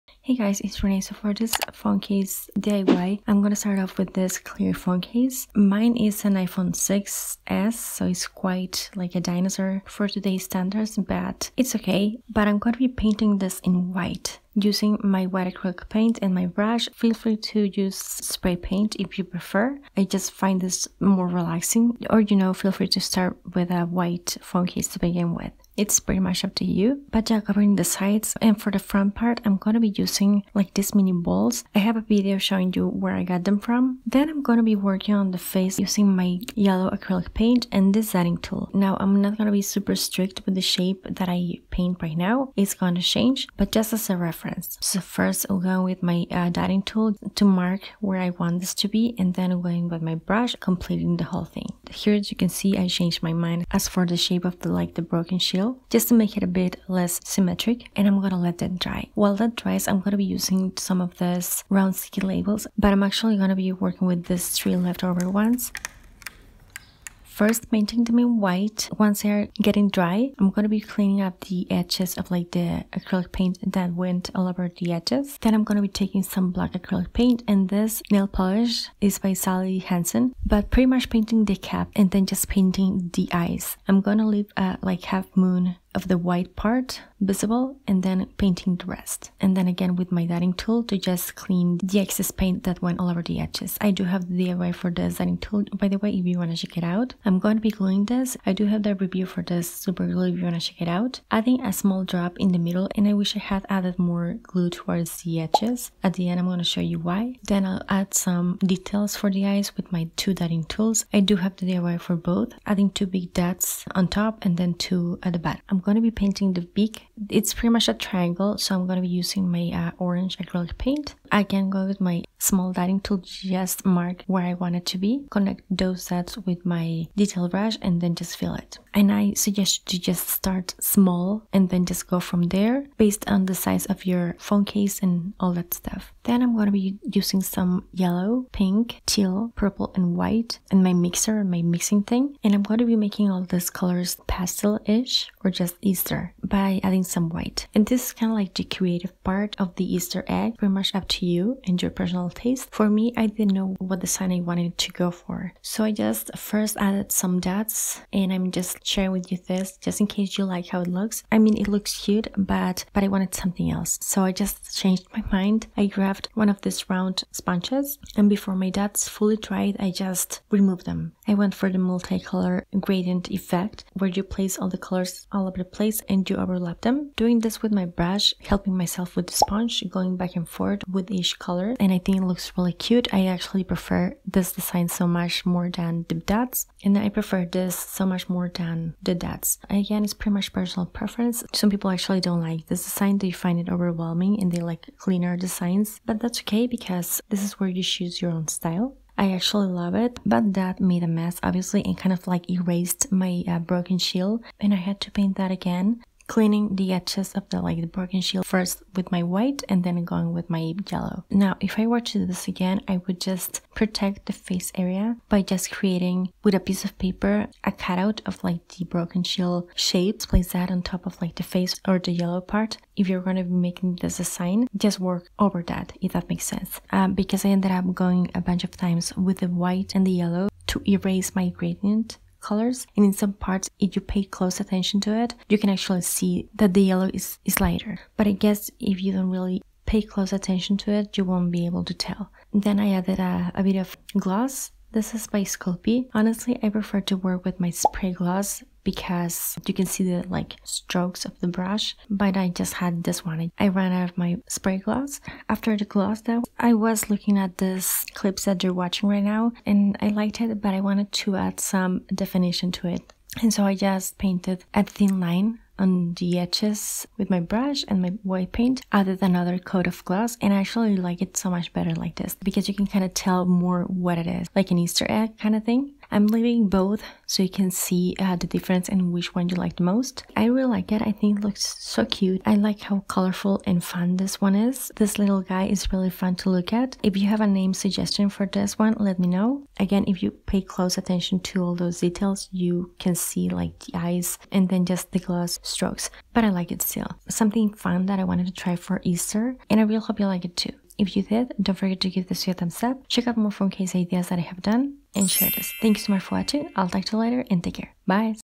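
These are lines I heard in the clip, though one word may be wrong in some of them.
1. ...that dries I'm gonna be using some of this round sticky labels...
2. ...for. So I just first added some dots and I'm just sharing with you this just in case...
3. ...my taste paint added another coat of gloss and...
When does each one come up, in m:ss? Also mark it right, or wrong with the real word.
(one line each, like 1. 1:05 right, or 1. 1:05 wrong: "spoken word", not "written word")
1. 0:59 right
2. 2:35 right
3. 4:28 wrong: "white", not "taste".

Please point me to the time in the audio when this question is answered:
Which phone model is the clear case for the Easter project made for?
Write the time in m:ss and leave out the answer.
0:06.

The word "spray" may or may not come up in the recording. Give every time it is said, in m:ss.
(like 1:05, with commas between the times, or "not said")
0:17, 4:07, 4:14.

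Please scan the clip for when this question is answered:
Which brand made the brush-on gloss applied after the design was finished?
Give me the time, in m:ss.
4:05.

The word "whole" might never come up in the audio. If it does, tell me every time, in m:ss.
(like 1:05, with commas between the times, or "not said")
0:51.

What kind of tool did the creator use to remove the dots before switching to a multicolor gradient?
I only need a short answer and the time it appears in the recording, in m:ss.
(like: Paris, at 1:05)
Round sponges, at 2:46.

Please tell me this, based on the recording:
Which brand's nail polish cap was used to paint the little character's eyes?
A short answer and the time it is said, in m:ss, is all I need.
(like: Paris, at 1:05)
Sally Hansen, at 1:19.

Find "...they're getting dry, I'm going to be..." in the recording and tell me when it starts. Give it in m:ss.
1:09.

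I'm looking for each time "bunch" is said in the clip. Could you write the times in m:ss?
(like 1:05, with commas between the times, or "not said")
3:48.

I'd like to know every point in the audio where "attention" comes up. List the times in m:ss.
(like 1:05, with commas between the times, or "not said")
3:54, 4:00, 4:50.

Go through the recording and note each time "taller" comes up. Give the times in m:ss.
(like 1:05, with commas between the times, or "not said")
not said.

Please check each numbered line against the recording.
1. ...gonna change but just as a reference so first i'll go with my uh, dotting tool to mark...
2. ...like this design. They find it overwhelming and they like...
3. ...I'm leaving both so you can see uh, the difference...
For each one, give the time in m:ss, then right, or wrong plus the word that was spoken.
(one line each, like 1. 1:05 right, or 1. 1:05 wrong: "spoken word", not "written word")
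1. 0:42 right
2. 3:12 right
3. 4:36 right.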